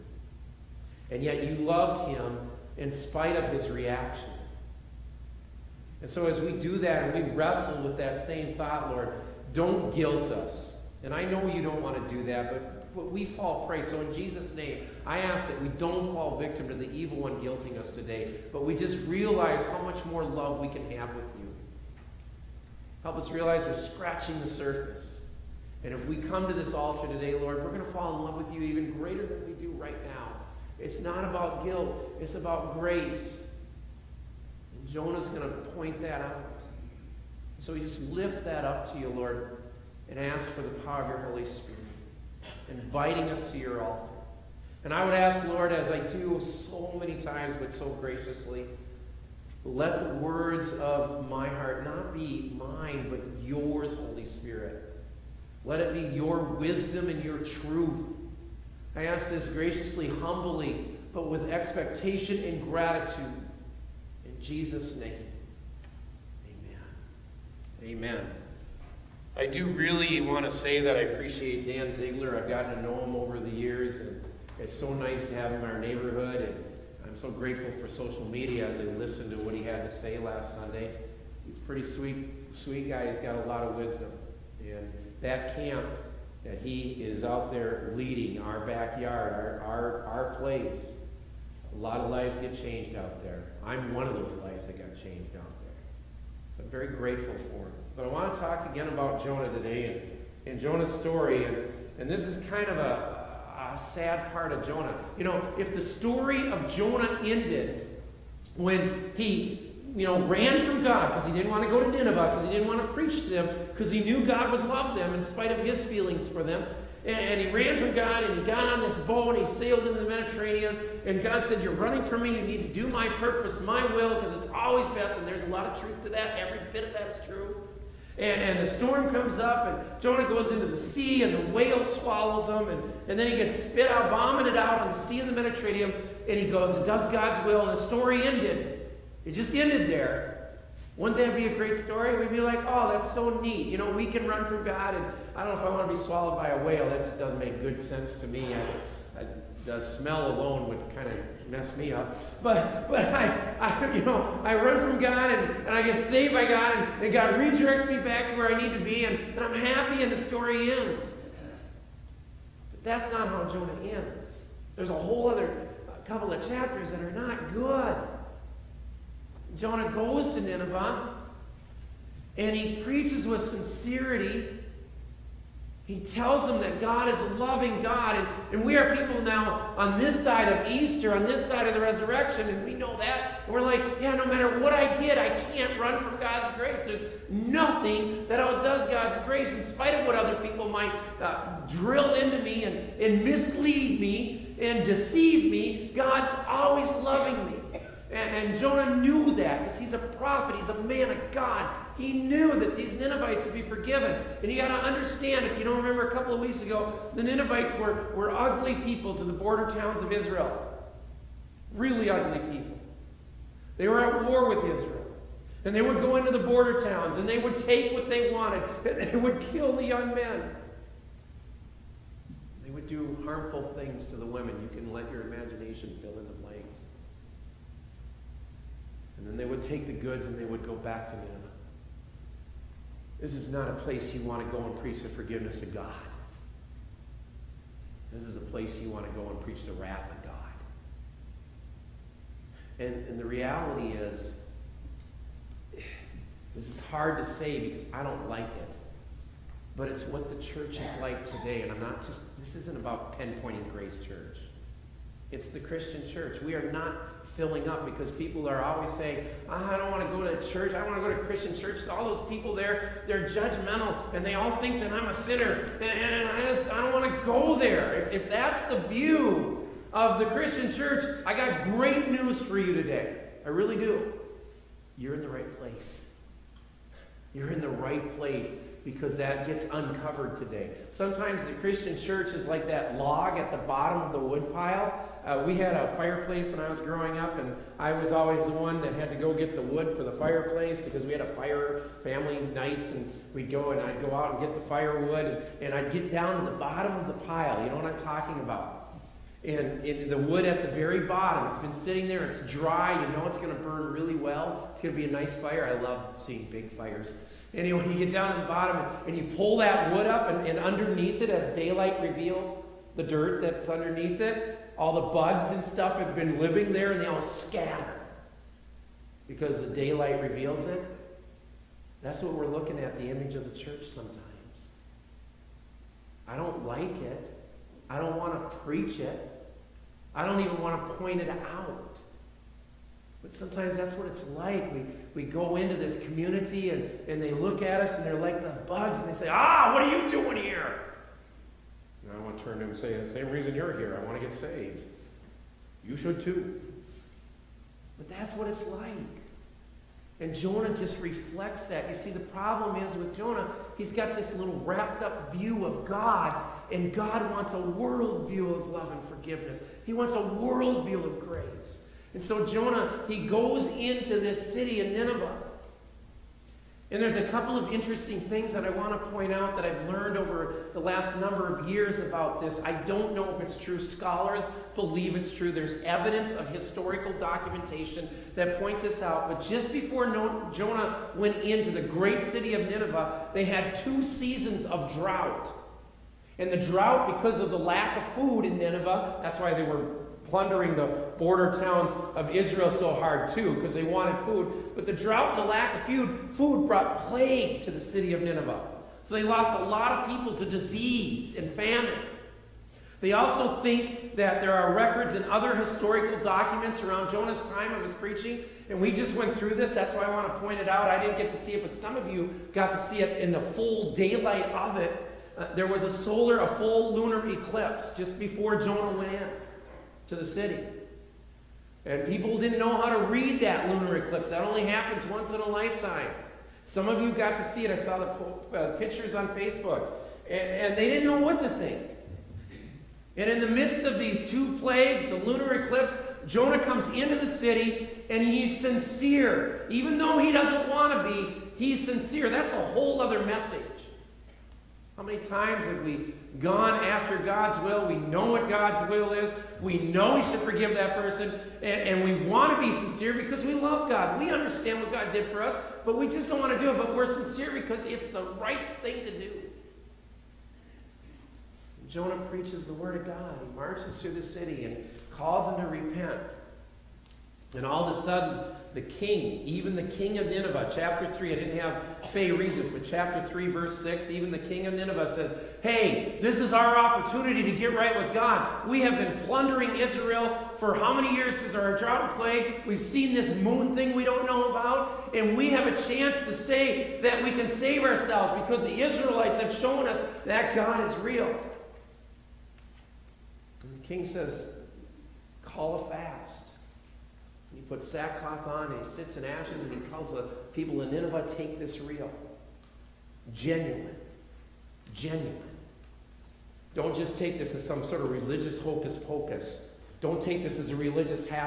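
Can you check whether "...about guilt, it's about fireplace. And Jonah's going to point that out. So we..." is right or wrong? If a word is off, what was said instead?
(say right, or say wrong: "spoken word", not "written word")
wrong: "grace", not "fireplace".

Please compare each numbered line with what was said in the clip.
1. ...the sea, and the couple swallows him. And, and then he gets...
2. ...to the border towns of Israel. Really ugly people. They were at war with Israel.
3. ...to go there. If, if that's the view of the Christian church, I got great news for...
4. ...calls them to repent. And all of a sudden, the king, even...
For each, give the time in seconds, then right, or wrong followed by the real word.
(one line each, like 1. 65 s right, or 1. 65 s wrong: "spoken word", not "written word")
1. 130 s wrong: "whale", not "couple"
2. 209 s right
3. 267 s right
4. 465 s right.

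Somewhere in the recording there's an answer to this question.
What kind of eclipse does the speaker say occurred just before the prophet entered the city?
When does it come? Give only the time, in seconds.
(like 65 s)
416 s.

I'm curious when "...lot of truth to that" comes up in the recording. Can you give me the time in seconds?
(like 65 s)
125 s.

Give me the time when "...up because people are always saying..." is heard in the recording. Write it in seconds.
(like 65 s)
257 s.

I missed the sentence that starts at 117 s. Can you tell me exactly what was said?
And, and, he ran from God and he got on this boat and he sailed into the Mediterranean.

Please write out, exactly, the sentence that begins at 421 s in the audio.
And people didn't know how to read that lunar eclipse.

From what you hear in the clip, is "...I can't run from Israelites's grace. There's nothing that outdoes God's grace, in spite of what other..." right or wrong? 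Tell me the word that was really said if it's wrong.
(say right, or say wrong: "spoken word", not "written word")
wrong: "God", not "Israelites".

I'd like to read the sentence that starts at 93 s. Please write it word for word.
I'm one of those lives that got changed out there.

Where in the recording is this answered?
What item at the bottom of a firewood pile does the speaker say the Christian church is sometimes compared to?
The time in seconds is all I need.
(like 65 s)
282 s.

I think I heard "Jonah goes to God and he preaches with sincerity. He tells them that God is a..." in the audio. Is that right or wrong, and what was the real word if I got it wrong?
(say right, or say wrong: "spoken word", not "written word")
wrong: "Nineveh", not "God".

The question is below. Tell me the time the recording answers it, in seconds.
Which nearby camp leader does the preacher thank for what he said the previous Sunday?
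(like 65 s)
71 s.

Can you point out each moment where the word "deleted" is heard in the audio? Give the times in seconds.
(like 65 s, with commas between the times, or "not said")
not said.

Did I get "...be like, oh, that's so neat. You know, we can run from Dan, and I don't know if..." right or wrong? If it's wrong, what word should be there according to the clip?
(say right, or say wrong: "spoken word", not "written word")
wrong: "God", not "Dan".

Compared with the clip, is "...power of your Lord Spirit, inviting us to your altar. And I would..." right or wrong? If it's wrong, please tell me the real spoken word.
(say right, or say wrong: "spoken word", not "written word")
wrong: "Holy", not "Lord".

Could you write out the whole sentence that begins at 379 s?
But just before Jonah went into the great city of Nineveh, they had two seasons of drought.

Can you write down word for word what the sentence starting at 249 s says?
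But it's what the church is like today.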